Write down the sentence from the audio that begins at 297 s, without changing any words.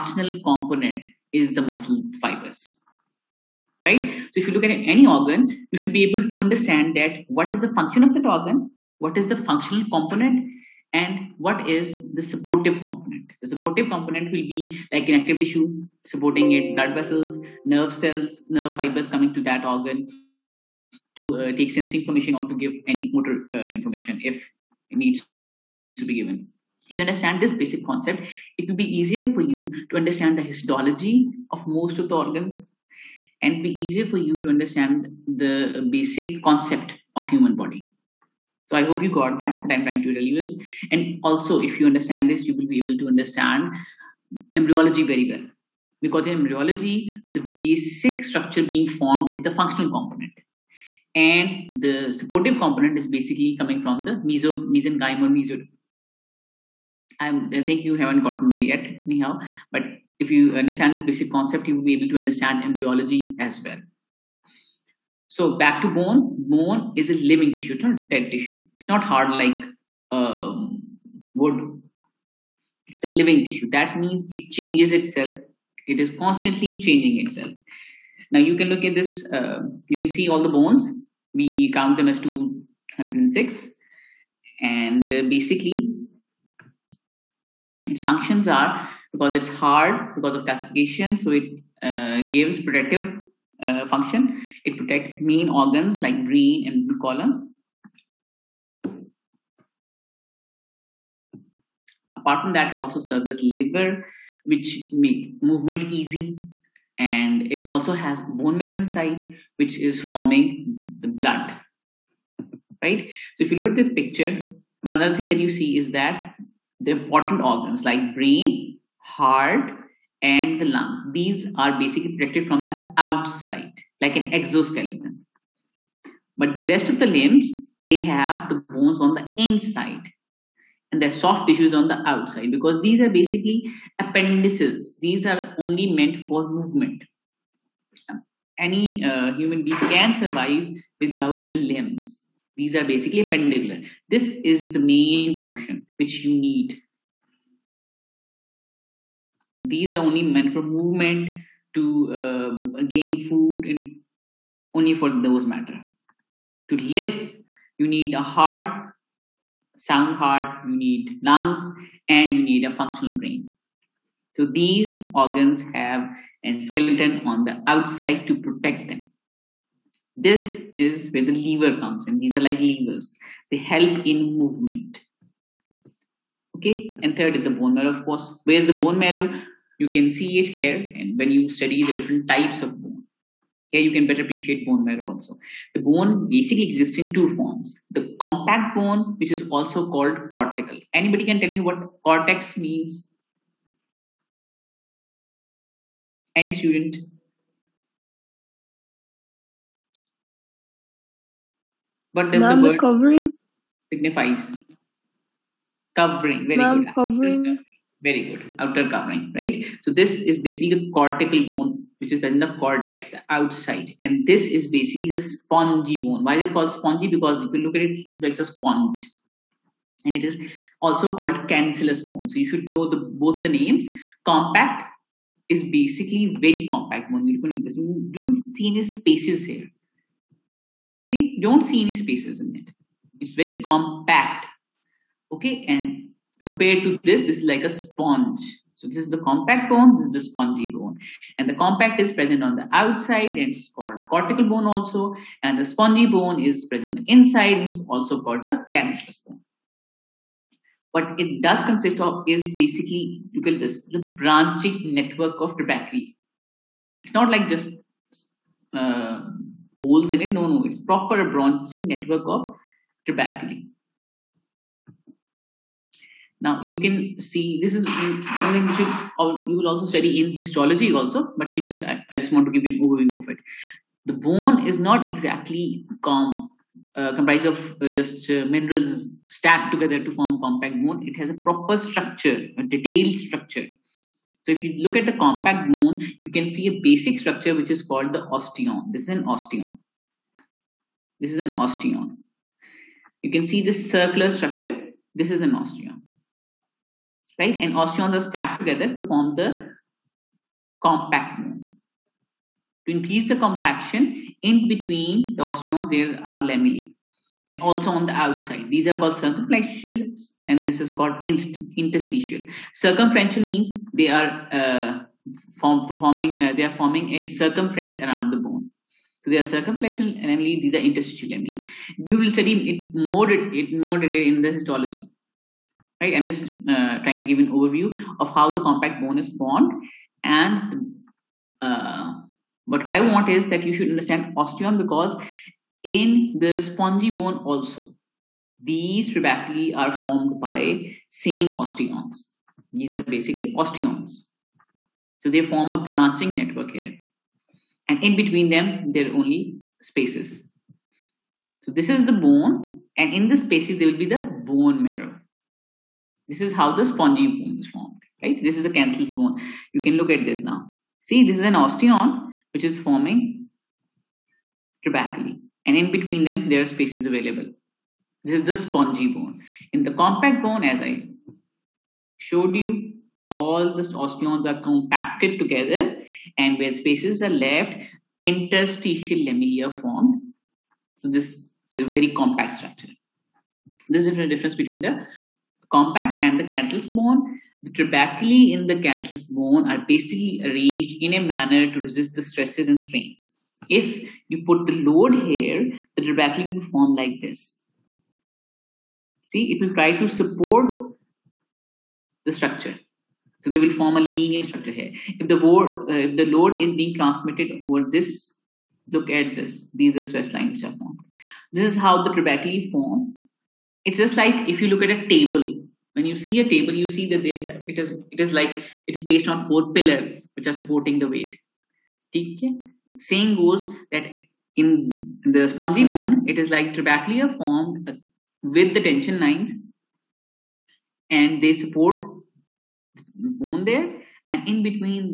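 And osteons are stacked together to form the compact bone.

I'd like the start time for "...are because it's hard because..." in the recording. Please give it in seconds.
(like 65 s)
88 s.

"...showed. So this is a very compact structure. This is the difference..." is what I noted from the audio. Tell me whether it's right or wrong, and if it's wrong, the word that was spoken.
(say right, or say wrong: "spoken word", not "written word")
wrong: "formed", not "showed".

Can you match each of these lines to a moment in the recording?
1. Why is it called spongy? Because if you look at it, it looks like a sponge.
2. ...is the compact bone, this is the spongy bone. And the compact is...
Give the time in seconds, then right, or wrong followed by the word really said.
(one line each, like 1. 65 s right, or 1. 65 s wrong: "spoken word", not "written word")
1. 216 s right
2. 238 s right.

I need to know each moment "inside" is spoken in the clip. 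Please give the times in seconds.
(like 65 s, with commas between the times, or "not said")
108 s, 129 s, 247 s.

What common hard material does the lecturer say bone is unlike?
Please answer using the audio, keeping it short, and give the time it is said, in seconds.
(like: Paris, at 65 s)
Wood, at 71 s.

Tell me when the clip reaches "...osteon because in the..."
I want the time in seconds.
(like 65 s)
334 s.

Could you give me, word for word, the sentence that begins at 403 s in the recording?
So they will form a linear structure here.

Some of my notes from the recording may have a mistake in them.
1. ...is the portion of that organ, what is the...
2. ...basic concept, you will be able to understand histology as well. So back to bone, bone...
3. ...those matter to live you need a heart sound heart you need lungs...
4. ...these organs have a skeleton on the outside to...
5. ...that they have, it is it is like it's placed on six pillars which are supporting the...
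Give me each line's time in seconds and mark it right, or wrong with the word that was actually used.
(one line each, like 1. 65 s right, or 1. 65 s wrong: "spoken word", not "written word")
1. 7 s wrong: "function", not "portion"
2. 61 s wrong: "embryology", not "histology"
3. 155 s right
4. 164 s right
5. 417 s wrong: "four", not "six".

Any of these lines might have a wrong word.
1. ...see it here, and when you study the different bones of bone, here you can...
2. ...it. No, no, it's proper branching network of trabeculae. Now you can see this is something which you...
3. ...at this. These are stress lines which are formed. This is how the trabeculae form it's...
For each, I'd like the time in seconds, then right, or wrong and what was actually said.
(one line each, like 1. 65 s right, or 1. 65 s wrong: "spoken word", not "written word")
1. 180 s wrong: "types", not "bones"
2. 260 s right
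3. 409 s right.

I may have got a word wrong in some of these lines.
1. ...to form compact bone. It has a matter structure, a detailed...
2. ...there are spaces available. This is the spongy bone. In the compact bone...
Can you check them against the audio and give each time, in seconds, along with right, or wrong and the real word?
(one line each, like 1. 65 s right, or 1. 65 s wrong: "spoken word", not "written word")
1. 280 s wrong: "proper", not "matter"
2. 366 s right.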